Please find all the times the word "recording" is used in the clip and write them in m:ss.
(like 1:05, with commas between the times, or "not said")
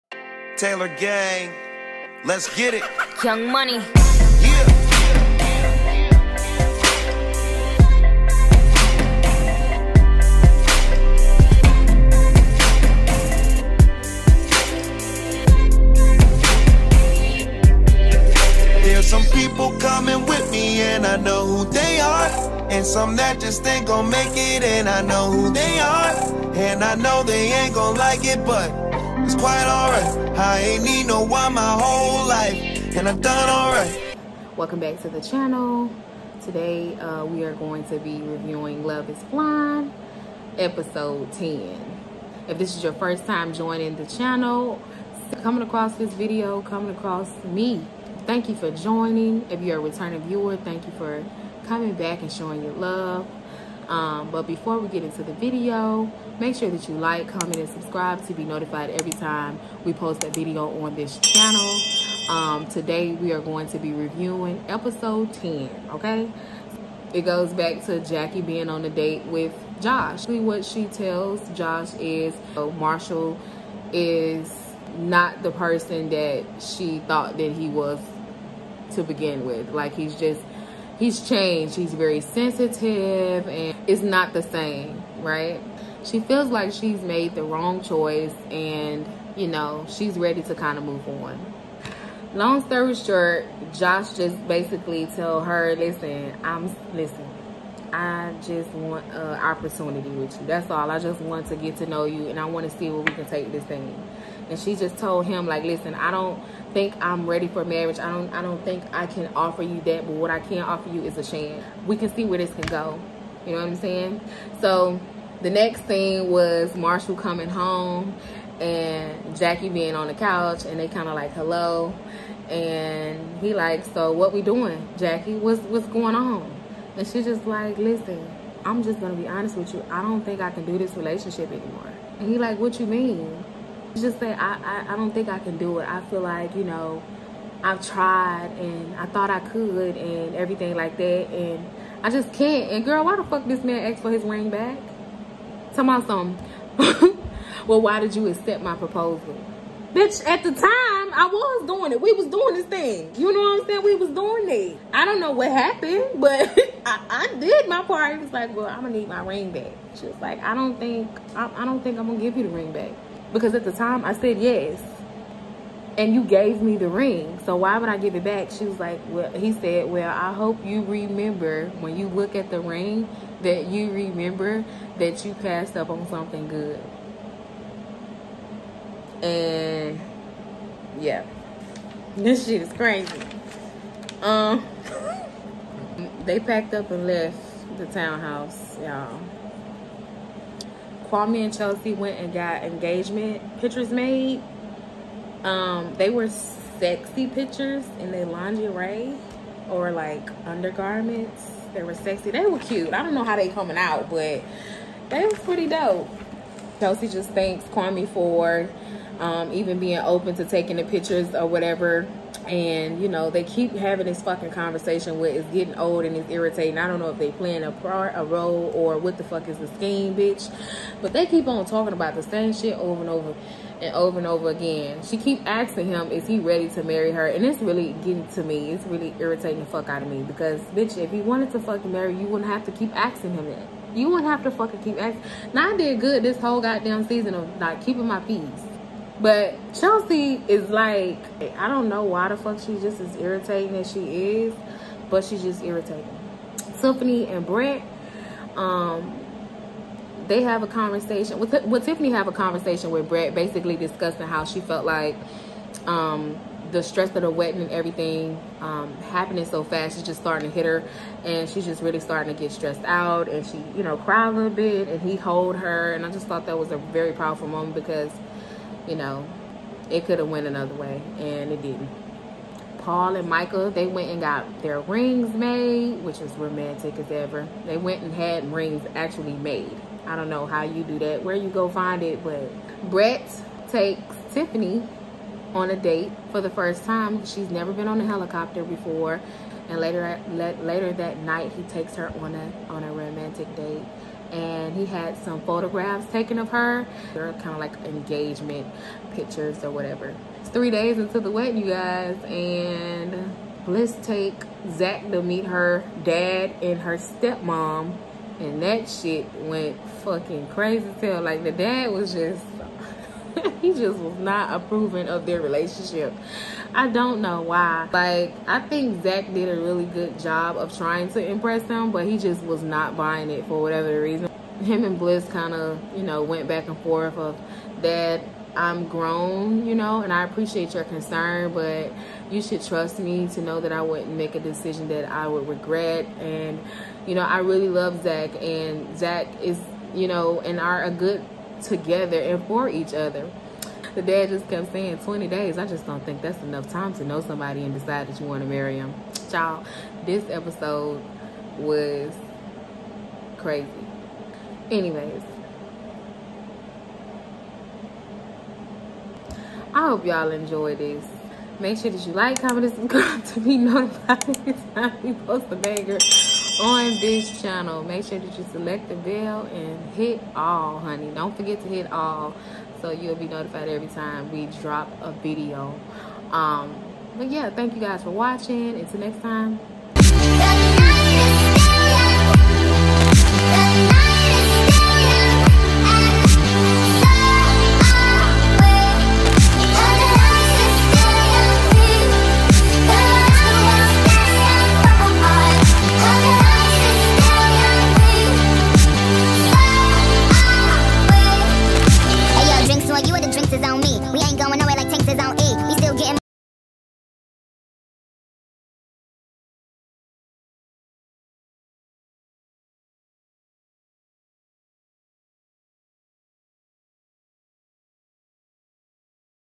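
not said.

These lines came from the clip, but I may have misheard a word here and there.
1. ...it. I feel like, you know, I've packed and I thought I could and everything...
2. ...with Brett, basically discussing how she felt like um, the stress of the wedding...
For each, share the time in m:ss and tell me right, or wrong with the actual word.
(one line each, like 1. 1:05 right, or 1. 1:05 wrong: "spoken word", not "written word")
1. 2:15 wrong: "tried", not "packed"
2. 4:12 right.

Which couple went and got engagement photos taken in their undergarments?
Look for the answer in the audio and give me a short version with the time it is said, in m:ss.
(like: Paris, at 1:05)
Kwame and Chelsea, at 3:11.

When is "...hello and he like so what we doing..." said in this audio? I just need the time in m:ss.
2:01.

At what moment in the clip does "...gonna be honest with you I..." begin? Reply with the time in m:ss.
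2:08.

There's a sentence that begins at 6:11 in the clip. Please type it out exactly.
Don't forget to hit all so you'll be notified every time we drop a video.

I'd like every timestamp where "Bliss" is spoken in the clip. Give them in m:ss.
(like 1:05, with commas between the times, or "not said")
5:24.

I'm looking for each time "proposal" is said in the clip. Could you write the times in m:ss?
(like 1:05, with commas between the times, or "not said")
2:28.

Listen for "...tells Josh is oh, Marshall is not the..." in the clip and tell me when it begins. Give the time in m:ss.
1:10.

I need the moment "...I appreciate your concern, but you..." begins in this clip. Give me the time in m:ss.
5:30.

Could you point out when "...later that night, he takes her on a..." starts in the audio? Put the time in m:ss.
4:50.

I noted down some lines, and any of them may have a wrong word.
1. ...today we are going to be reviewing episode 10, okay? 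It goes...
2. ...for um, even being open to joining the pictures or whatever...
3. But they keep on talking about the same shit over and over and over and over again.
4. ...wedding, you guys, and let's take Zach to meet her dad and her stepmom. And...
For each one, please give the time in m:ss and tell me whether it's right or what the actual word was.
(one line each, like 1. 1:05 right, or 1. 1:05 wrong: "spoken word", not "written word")
1. 1:02 right
2. 3:28 wrong: "taking", not "joining"
3. 3:41 right
4. 5:01 right.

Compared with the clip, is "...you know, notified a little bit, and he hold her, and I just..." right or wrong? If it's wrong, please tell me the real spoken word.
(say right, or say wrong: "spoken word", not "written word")
wrong: "cried", not "notified".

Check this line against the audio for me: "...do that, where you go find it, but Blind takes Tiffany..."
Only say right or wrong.
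wrong.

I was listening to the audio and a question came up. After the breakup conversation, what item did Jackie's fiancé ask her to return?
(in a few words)
his ring.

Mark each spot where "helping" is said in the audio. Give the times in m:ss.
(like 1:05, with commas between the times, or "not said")
not said.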